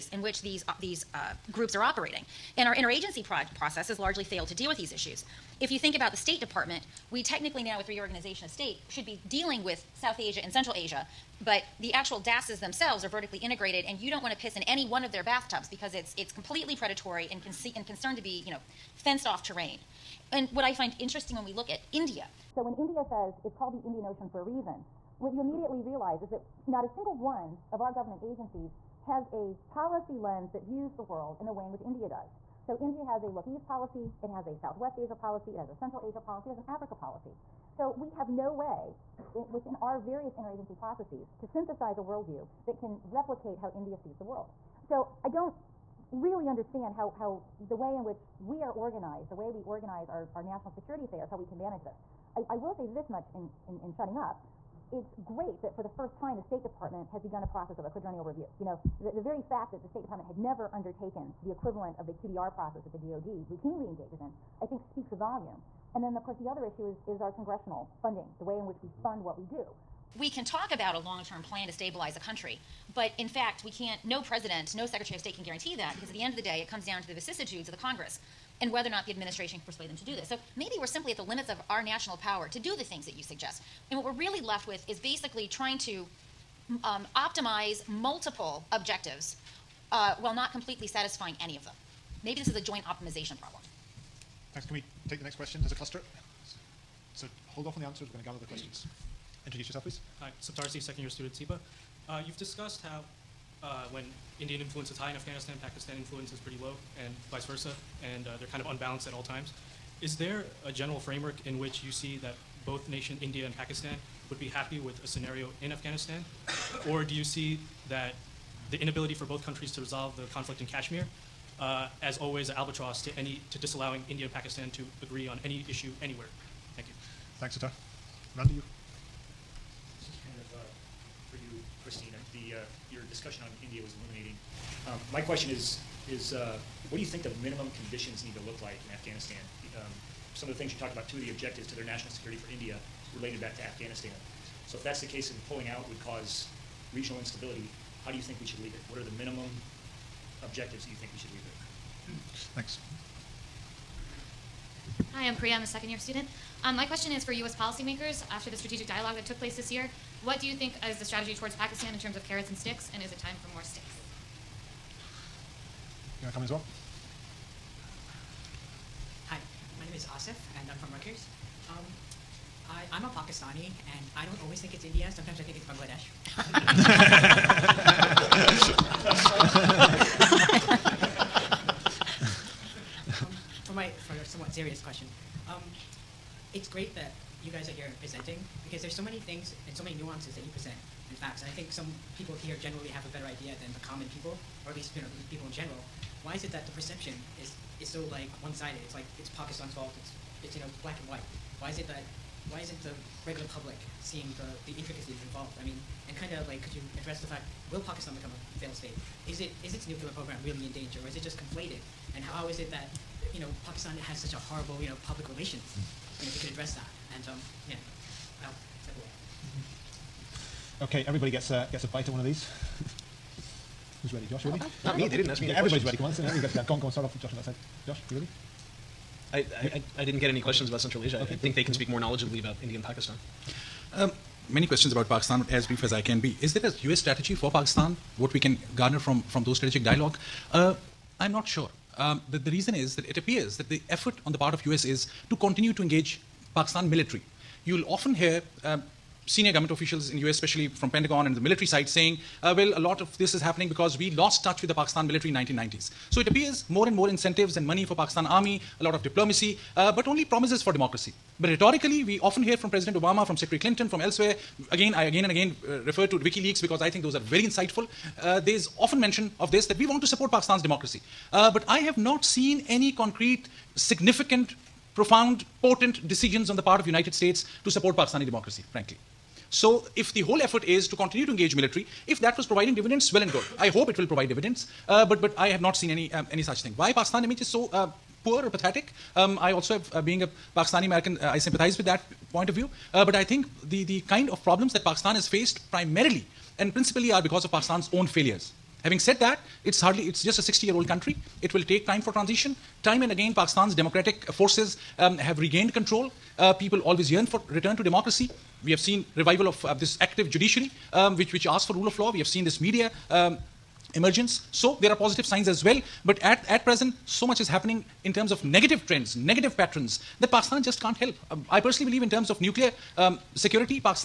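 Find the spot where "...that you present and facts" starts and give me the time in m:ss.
3:10.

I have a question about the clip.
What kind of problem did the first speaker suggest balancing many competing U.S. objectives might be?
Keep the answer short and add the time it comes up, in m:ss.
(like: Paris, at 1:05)
joint optimization problem, at 1:32.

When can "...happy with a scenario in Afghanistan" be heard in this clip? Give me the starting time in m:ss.
1:54.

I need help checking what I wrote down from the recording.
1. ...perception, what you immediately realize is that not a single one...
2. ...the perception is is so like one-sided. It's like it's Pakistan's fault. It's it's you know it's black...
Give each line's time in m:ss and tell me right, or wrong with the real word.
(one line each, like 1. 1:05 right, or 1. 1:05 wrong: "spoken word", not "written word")
1. 0:24 wrong: "reason", not "perception"
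2. 3:16 right.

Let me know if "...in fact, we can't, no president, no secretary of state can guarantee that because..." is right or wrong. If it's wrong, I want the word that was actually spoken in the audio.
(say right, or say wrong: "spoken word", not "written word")
right.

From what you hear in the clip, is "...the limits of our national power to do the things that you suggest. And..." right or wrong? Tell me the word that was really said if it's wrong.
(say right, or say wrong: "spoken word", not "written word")
right.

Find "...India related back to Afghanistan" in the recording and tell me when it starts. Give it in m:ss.
2:22.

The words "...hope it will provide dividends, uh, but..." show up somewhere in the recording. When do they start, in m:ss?
4:43.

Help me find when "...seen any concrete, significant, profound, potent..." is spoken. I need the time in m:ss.
4:32.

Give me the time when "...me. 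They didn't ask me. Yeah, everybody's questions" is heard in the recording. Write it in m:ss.
3:44.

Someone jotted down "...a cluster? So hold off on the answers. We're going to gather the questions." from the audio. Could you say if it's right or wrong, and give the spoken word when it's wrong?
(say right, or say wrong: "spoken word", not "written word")
right.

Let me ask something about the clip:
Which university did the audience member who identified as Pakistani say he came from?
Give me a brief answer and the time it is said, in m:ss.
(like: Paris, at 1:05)
Rutgers, at 2:50.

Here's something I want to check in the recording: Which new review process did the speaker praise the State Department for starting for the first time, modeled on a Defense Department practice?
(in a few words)
quadrennial review.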